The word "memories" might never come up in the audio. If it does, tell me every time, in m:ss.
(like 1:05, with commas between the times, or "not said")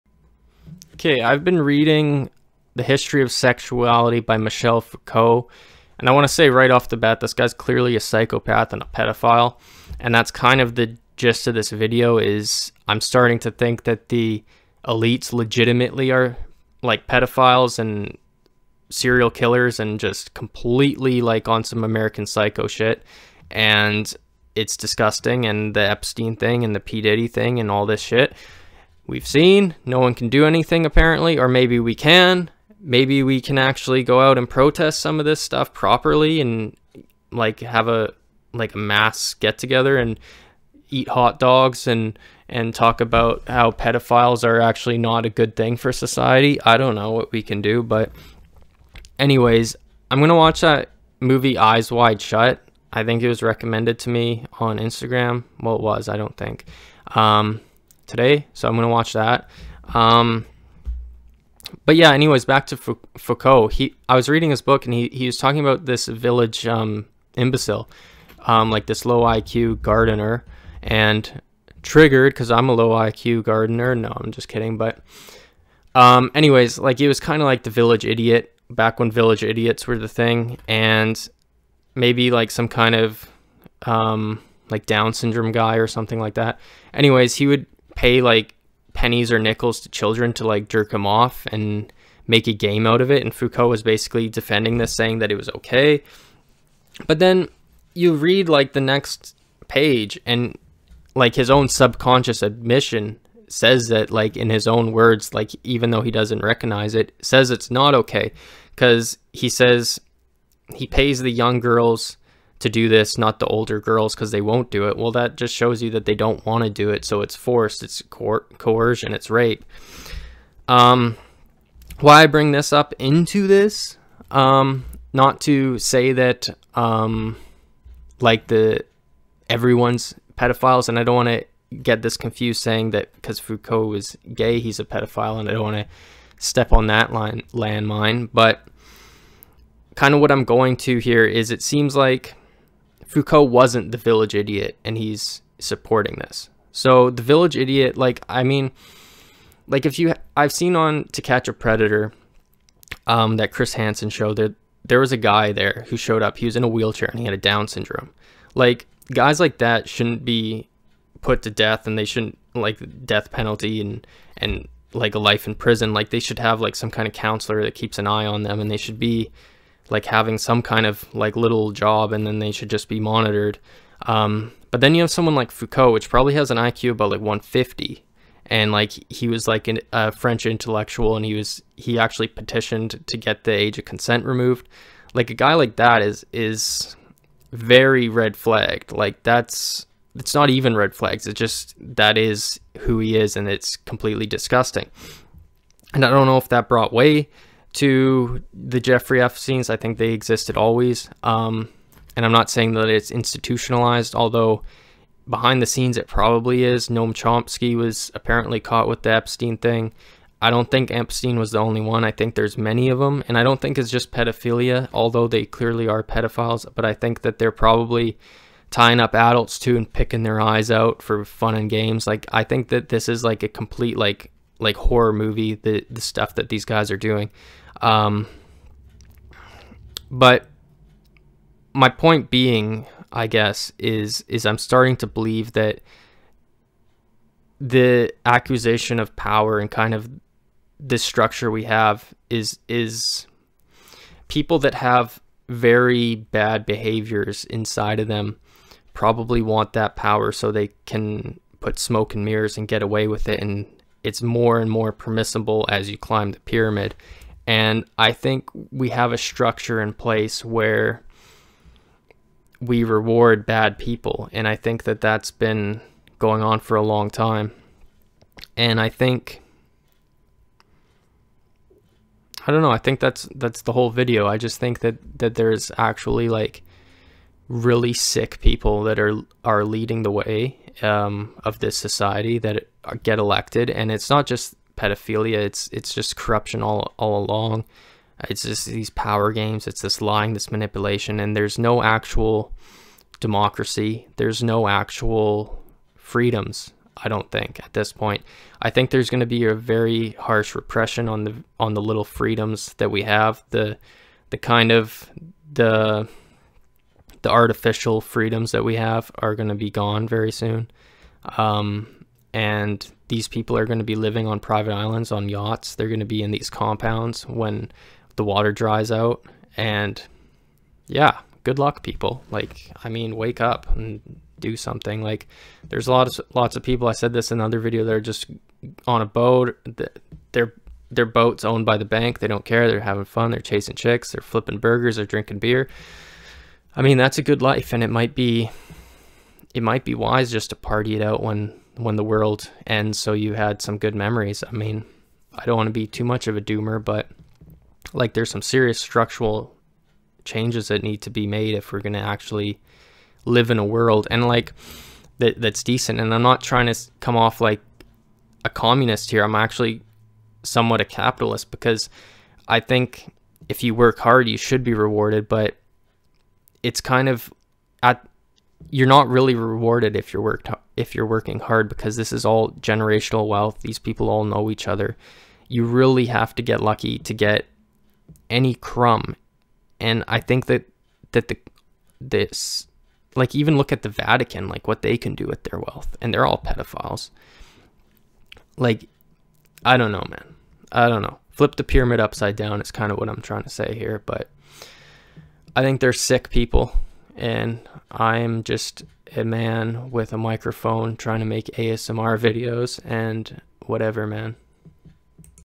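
5:43.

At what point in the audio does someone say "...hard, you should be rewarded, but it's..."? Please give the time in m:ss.
6:03.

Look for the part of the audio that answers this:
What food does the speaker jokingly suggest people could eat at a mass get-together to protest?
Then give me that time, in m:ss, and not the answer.
0:41.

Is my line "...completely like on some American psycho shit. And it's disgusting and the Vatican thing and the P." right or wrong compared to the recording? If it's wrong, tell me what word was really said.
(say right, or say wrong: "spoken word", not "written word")
wrong: "Epstein", not "Vatican".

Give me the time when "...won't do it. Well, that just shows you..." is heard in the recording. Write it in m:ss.
1:54.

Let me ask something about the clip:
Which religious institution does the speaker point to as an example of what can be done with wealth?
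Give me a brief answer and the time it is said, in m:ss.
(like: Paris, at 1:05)
The Vatican, at 6:23.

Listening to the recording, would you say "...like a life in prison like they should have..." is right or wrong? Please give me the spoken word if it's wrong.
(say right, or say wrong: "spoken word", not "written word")
right.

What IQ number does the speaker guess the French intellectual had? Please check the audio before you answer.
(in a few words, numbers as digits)
150.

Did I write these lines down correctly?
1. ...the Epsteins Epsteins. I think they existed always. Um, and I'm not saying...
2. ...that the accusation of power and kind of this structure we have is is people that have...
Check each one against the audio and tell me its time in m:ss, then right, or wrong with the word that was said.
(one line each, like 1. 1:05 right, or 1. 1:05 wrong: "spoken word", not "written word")
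1. 3:18 wrong: "Jeffrey", not "Epsteins"
2. 3:55 right.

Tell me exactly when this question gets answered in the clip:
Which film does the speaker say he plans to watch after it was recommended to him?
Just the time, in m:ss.
0:51.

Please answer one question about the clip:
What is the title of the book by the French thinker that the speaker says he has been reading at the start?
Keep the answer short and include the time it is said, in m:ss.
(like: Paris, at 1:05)
The History of Sexuality, at 0:02.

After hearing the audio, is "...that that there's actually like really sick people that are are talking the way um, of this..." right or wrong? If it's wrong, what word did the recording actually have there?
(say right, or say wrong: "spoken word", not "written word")
wrong: "leading", not "talking".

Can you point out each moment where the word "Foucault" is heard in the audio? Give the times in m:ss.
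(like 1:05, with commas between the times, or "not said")
0:04, 1:02, 1:33, 2:13, 2:23, 2:55.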